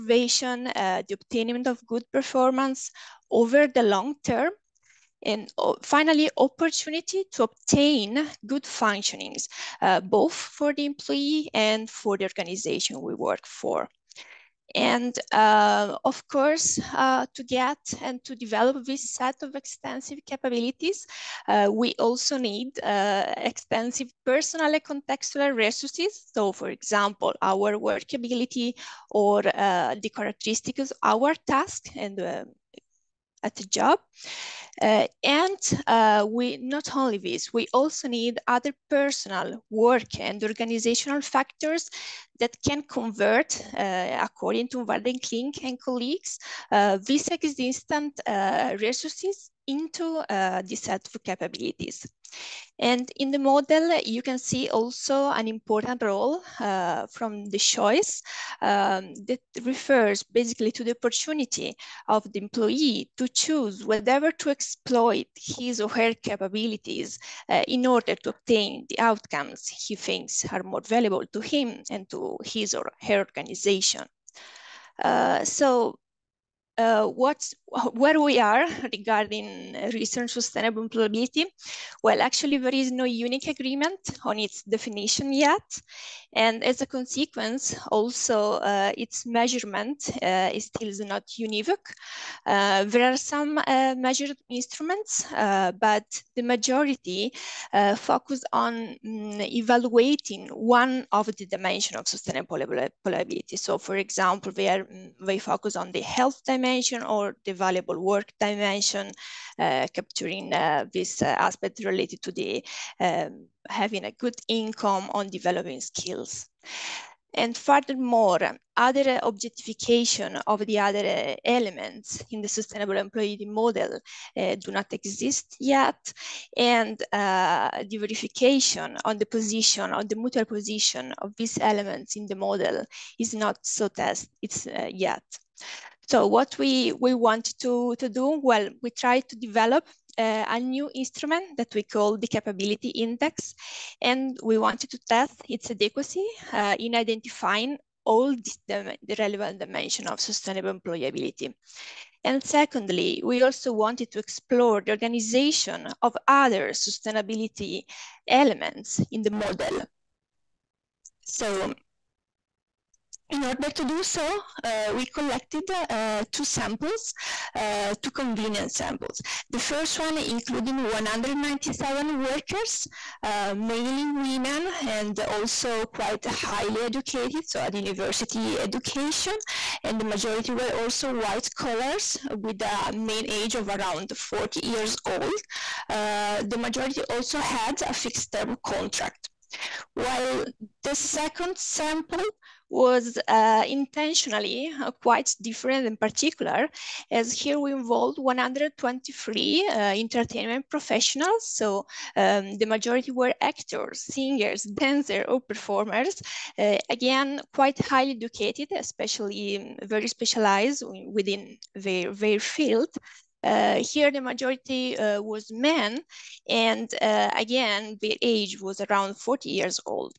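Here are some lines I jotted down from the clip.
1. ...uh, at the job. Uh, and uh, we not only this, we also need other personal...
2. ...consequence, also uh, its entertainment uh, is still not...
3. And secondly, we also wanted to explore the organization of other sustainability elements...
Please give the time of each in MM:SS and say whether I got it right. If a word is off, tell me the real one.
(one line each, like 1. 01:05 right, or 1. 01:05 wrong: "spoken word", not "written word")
1. 00:32 right
2. 01:26 wrong: "measurement", not "entertainment"
3. 02:32 right.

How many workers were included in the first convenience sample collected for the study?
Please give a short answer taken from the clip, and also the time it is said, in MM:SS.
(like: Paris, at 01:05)
197, at 02:50.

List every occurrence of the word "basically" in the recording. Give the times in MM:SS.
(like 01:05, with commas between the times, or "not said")
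01:00.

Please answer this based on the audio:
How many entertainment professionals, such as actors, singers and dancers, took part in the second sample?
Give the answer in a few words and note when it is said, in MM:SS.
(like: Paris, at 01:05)
123, at 03:18.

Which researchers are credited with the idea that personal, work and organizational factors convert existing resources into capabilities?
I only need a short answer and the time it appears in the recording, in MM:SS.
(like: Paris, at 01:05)
Van Klink and colleagues, at 00:44.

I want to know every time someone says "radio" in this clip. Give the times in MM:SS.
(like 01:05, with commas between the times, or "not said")
not said.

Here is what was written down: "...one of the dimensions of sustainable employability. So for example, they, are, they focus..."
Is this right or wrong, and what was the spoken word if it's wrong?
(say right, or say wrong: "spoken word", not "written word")
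right.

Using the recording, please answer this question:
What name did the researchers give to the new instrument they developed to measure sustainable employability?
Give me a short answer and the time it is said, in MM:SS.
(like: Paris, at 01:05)
capability index, at 02:22.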